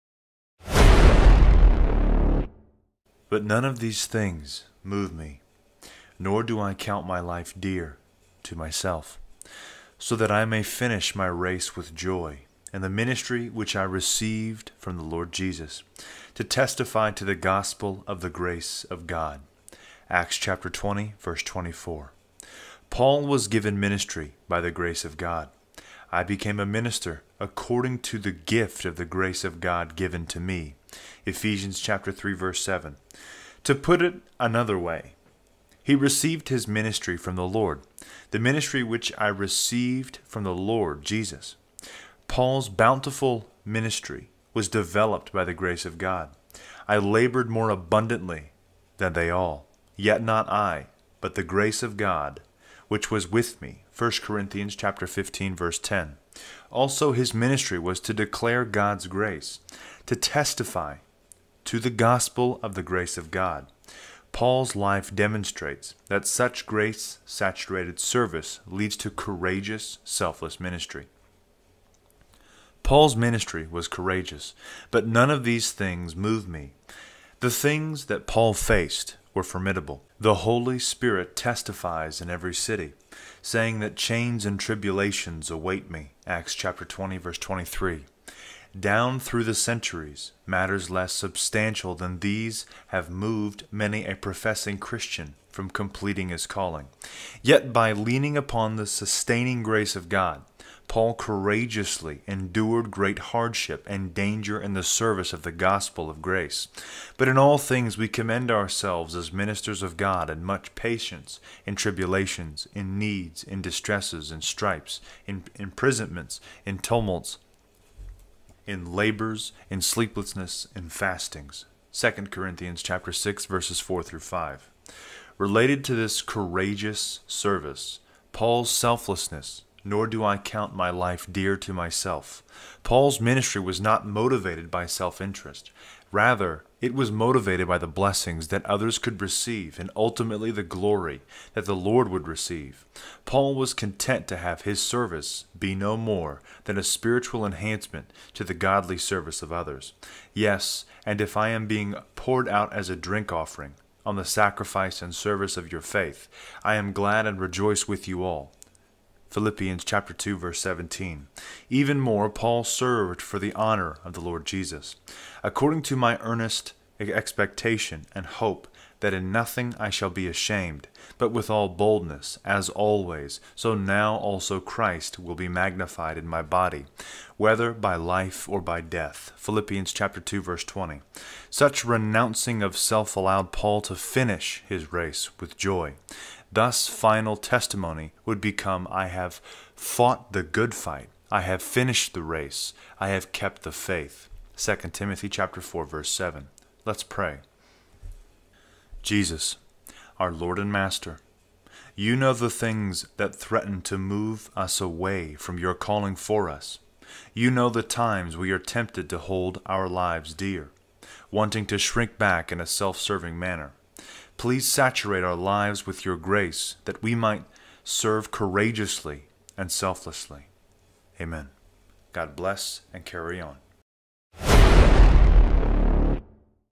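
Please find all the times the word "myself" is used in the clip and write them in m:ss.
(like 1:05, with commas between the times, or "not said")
0:08, 2:11.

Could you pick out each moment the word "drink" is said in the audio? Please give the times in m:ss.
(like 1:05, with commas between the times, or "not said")
2:32.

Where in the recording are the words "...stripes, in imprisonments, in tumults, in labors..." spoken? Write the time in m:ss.
1:54.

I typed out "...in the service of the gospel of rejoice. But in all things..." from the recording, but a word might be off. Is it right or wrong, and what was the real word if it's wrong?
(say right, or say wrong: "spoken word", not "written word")
wrong: "grace", not "rejoice".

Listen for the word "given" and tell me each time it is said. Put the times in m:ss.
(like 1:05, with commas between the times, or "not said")
0:23, 0:29.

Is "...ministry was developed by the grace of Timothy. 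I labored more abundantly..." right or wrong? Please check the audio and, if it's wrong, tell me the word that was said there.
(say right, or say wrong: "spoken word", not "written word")
wrong: "God", not "Timothy".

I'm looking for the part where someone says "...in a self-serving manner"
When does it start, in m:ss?
3:32.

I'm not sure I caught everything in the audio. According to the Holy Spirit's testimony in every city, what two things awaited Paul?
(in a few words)
Chains and tribulations.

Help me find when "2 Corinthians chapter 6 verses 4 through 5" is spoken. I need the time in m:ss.
2:01.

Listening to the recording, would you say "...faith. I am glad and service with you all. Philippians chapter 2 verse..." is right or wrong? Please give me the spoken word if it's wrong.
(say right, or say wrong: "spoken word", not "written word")
wrong: "rejoice", not "service".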